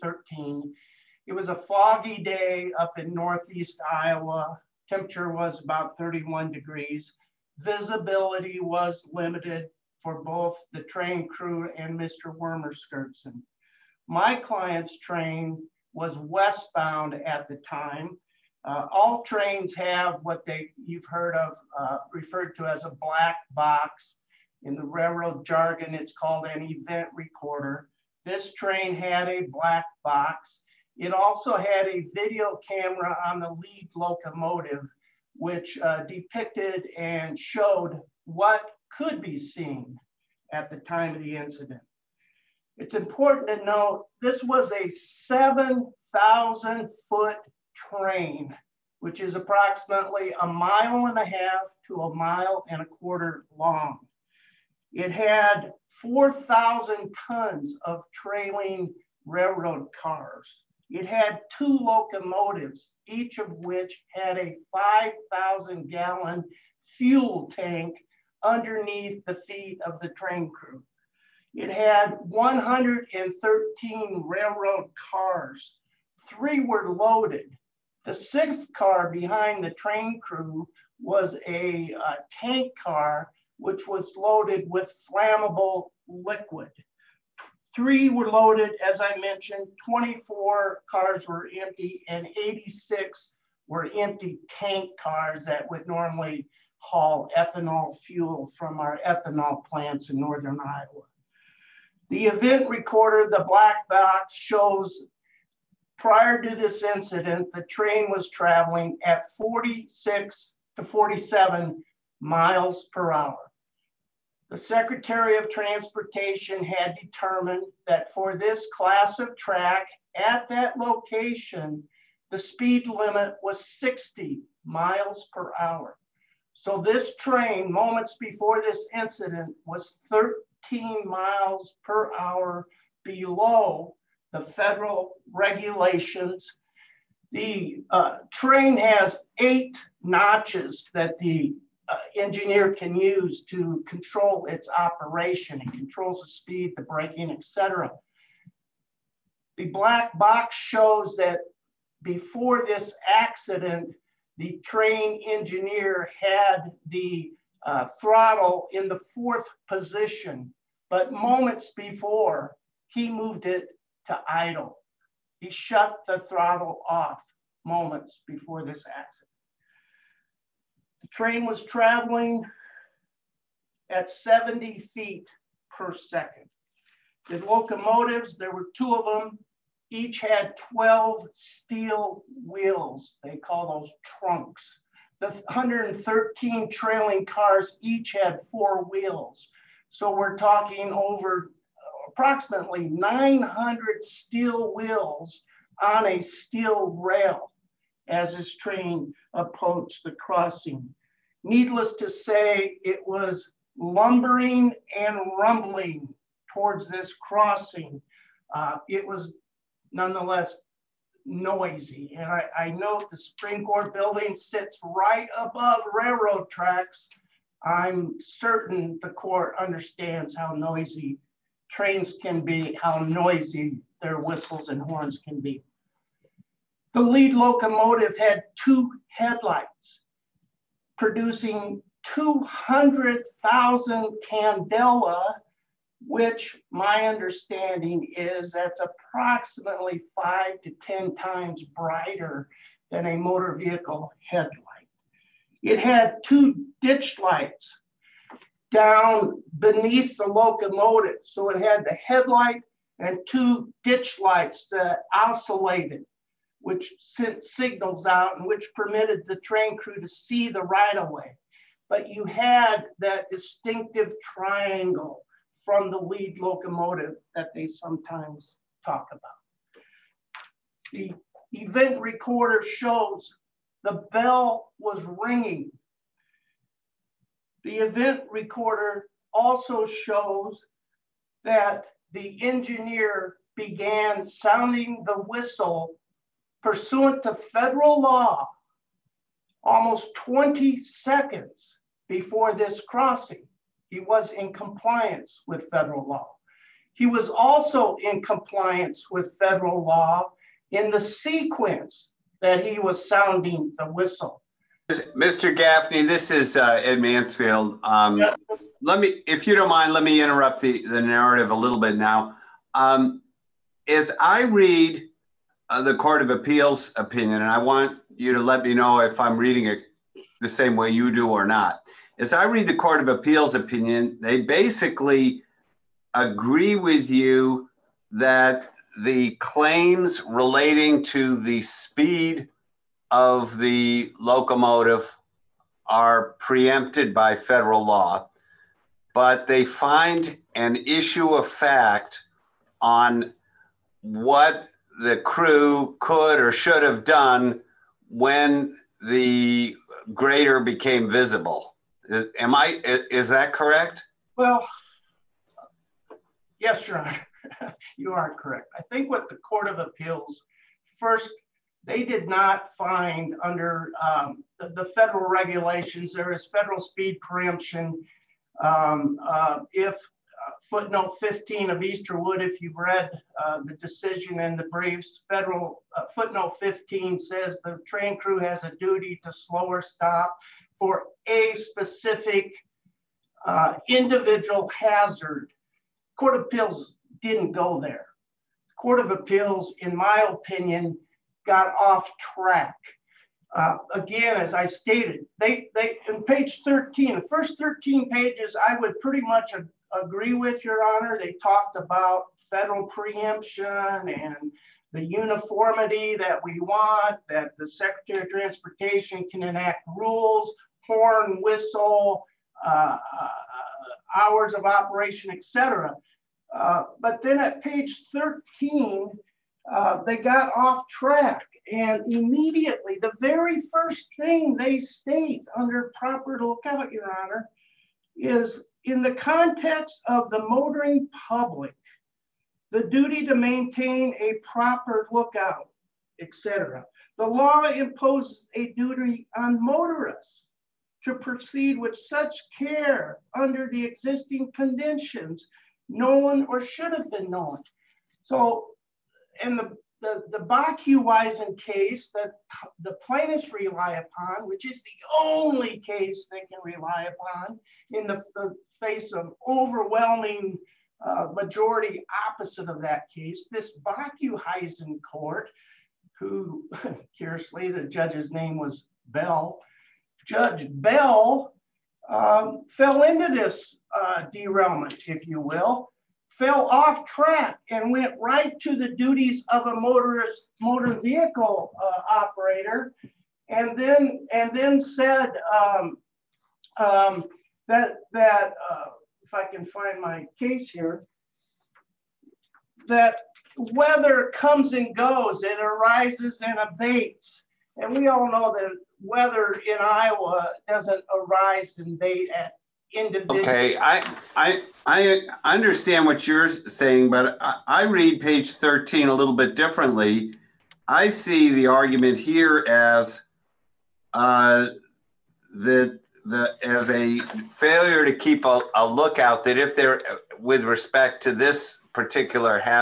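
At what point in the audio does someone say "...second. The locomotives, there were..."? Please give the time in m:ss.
2:55.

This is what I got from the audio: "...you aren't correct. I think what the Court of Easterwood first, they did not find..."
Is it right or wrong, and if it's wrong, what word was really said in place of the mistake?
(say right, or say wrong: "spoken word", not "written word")
wrong: "Appeals", not "Easterwood".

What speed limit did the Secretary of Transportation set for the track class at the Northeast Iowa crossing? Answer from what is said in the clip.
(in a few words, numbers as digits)
60 mph.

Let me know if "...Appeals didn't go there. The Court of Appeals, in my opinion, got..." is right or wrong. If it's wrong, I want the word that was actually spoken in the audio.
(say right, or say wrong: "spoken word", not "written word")
right.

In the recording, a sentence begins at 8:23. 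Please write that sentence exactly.
Okay, I I I understand what you're saying, but I, I read page 13 a little bit differently.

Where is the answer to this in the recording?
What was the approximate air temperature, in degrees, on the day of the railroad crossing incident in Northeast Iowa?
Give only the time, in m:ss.
0:05.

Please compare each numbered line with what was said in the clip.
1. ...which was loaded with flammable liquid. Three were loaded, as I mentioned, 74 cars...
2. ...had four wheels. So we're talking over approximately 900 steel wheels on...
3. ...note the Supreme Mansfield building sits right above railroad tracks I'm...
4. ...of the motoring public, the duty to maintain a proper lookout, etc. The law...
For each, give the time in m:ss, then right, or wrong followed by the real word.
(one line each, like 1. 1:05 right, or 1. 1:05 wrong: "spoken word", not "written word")
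1. 1:23 wrong: "24", not "74"
2. 3:08 right
3. 3:32 wrong: "Court", not "Mansfield"
4. 7:10 right.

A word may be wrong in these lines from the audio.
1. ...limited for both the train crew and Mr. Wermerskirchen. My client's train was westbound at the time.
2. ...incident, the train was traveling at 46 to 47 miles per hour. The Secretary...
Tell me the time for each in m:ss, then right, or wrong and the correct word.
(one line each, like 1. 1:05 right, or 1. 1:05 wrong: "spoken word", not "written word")
1. 0:09 right
2. 1:46 right.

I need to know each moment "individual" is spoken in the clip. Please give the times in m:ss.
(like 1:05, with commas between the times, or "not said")
6:23, 8:22.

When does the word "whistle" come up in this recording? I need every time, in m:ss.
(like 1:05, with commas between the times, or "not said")
3:44, 4:45, 5:03, 6:51.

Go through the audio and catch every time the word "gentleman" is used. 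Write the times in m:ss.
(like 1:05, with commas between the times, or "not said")
not said.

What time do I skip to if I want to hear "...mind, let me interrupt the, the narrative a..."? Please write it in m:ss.
5:09.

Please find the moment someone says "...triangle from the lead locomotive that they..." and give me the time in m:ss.
4:24.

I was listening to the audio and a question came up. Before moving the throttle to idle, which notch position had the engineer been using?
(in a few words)
fourth.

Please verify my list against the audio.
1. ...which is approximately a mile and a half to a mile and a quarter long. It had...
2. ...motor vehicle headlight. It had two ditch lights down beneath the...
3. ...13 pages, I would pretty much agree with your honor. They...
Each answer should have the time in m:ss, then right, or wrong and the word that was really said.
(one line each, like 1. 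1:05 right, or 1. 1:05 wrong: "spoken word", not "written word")
1. 0:48 right
2. 4:03 right
3. 6:37 right.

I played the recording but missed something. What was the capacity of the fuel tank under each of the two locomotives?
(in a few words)
5,000 gallons.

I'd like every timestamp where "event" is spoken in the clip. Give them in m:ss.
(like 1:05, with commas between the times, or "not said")
0:26, 1:42, 4:31, 4:37.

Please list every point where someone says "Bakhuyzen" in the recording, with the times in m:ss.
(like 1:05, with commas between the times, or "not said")
7:30, 7:43.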